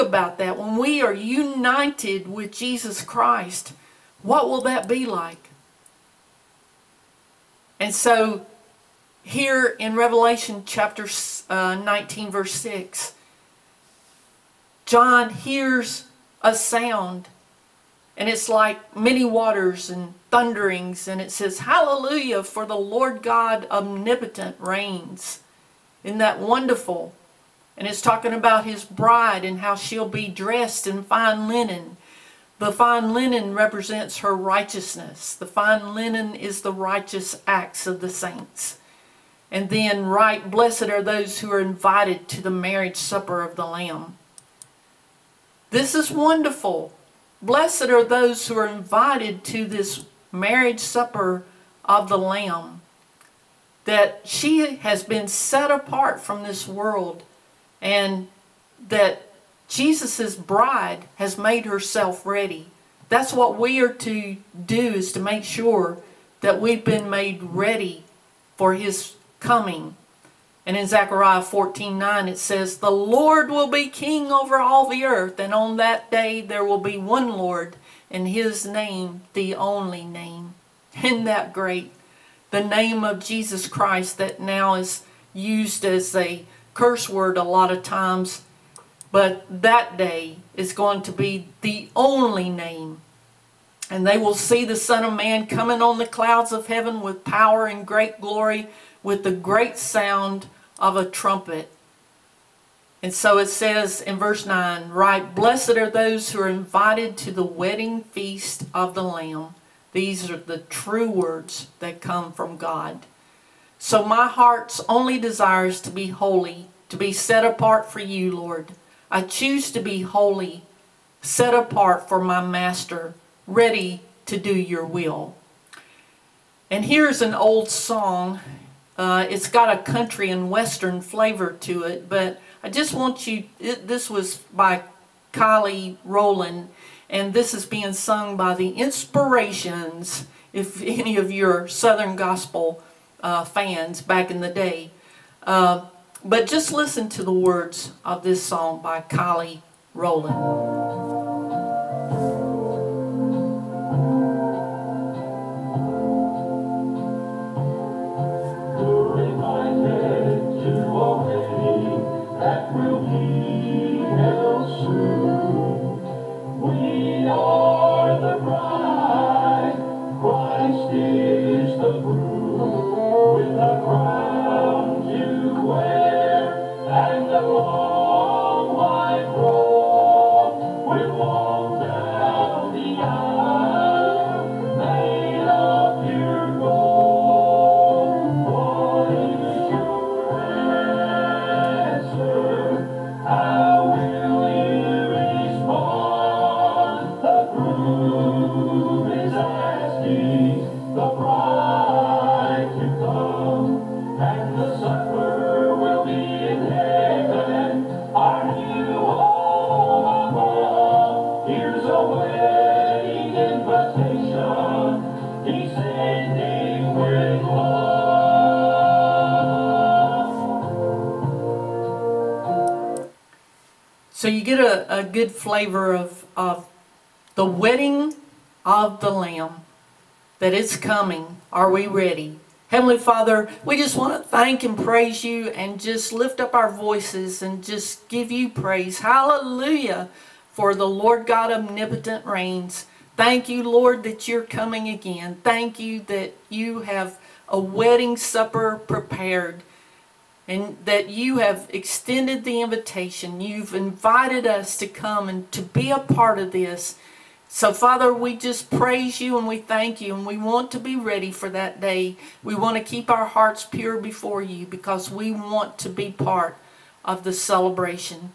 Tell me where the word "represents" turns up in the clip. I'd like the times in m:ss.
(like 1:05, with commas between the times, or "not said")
0:33.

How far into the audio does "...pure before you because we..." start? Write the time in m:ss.
4:23.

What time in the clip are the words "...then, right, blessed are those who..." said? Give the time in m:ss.
0:39.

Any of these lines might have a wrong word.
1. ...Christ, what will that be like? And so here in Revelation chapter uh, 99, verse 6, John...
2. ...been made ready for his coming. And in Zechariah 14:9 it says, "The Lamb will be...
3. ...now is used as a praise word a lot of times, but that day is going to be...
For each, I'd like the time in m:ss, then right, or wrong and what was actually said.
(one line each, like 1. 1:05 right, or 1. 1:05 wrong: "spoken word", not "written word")
1. 0:03 wrong: "19", not "99"
2. 1:06 wrong: "Lord", not "Lamb"
3. 1:24 wrong: "curse", not "praise".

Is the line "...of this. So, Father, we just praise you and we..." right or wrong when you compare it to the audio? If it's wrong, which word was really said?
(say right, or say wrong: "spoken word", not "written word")
right.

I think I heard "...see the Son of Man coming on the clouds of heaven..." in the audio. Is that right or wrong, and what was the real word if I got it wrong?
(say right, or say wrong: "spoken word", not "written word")
right.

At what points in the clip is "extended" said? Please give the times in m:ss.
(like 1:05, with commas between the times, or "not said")
4:11.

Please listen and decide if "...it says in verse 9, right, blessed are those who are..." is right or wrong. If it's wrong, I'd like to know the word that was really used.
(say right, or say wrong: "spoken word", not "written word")
right.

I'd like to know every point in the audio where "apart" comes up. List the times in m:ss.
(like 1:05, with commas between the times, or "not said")
0:55, 1:57, 2:01.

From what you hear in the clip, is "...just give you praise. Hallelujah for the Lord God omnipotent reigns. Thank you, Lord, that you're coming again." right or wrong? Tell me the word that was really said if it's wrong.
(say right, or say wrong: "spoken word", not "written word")
right.